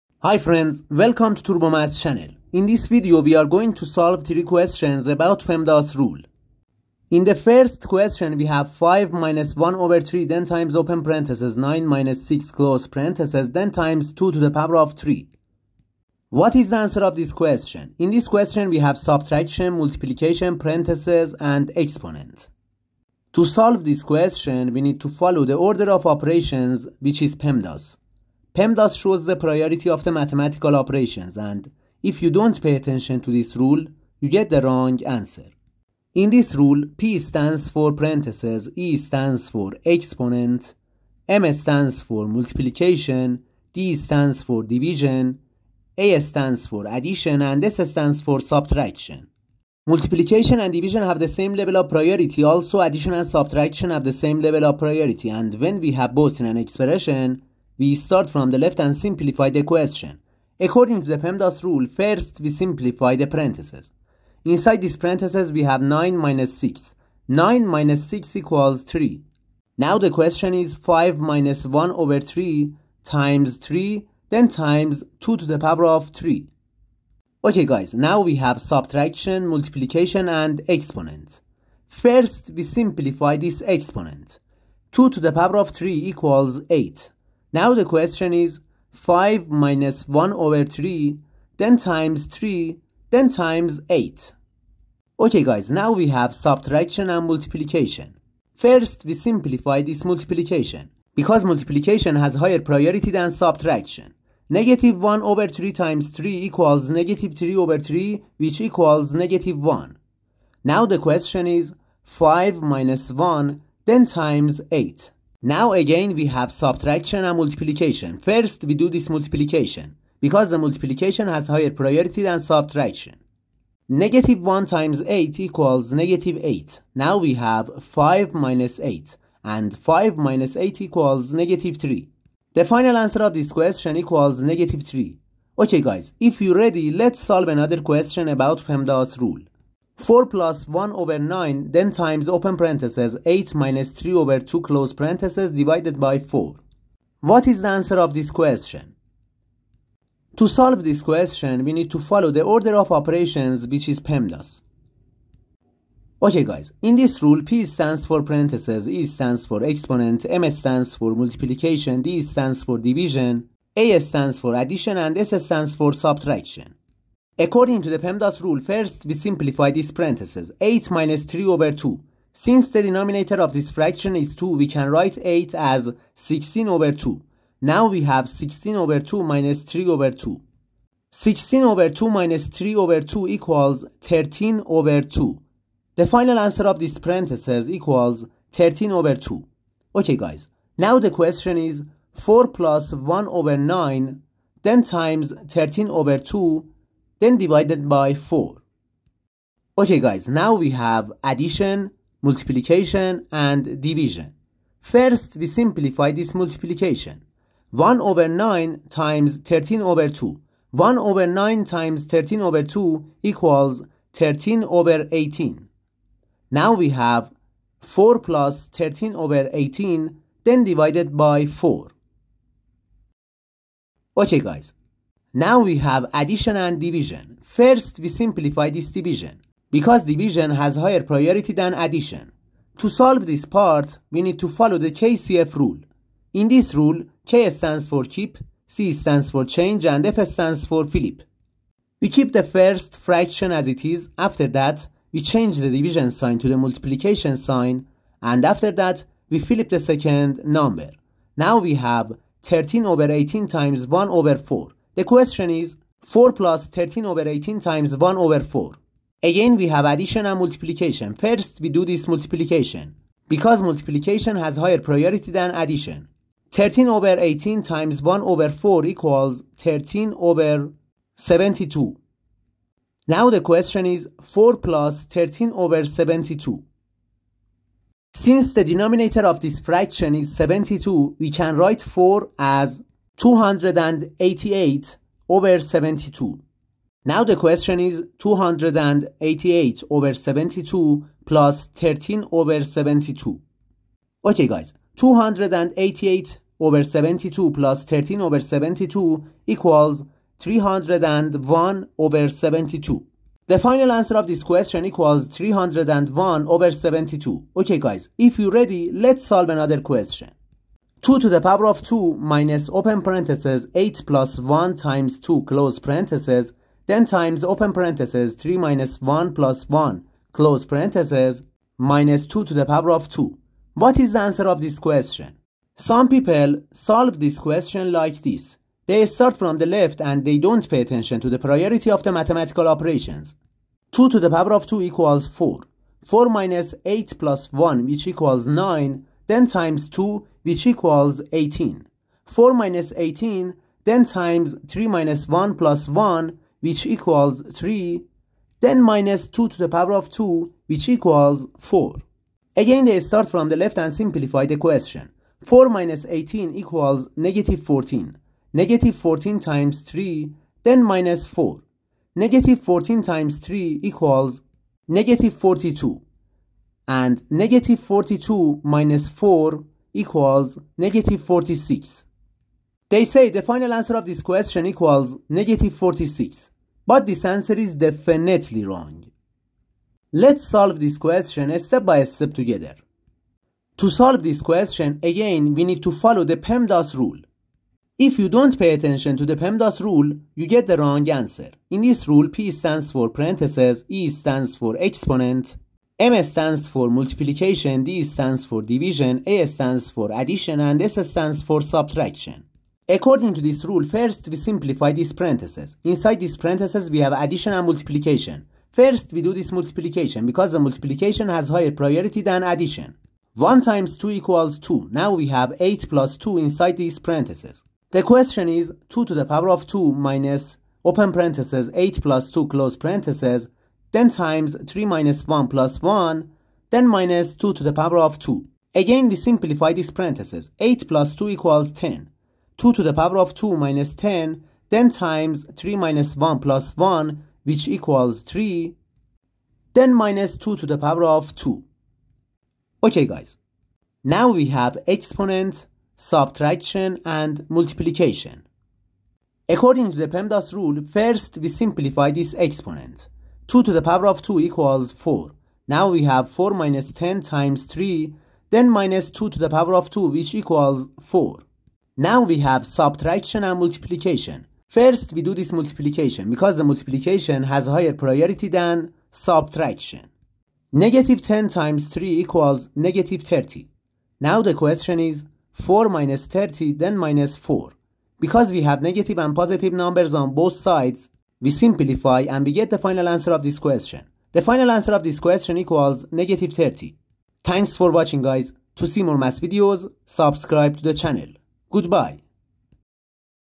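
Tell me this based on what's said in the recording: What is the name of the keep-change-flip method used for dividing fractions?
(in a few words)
KCF rule.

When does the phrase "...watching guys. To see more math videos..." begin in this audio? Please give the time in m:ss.
8:07.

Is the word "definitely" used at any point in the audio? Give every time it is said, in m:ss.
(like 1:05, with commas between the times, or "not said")
6:17.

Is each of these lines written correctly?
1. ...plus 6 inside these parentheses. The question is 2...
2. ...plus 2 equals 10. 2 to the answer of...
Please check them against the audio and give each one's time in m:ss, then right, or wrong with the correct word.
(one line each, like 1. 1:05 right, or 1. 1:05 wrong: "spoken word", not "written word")
1. 6:55 wrong: "2", not "6"
2. 7:10 wrong: "power", not "answer".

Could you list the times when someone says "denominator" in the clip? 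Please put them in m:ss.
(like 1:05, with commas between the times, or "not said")
2:52, 4:38.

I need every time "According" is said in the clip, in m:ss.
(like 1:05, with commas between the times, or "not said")
1:00, 2:47, 6:42, 7:29.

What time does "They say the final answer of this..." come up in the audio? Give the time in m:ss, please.
6:12.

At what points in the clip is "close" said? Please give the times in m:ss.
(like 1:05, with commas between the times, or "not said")
0:12, 2:24, 5:15, 5:20, 7:02.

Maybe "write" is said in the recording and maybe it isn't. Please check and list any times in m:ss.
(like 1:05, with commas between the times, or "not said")
2:54, 4:41.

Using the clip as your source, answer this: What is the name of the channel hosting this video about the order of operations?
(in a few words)
TurboMath.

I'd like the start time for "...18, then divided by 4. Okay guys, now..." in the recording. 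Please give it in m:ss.
3:39.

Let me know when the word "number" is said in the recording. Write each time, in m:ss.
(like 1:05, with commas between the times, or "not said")
4:10, 7:59.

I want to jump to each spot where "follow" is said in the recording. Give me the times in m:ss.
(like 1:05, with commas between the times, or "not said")
0:25, 2:31, 3:54, 6:25.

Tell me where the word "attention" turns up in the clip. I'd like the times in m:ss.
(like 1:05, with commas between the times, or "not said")
0:32, 5:30, 6:28.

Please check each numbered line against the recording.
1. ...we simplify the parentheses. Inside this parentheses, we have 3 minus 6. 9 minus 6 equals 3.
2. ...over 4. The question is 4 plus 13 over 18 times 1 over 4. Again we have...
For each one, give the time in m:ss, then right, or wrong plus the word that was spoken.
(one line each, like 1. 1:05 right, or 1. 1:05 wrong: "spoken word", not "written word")
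1. 1:02 wrong: "9", not "3"
2. 4:14 right.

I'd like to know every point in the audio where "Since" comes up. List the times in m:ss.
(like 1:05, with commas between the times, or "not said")
2:52, 4:38.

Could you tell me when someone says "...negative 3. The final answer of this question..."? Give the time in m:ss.
2:11.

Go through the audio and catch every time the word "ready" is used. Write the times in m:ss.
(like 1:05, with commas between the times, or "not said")
2:16.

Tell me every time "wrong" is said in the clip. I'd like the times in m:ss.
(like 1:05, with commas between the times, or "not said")
0:34, 6:18, 6:30.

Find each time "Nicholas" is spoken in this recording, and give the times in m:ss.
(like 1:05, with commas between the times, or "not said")
not said.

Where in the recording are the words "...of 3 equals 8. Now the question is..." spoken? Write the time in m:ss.
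1:25.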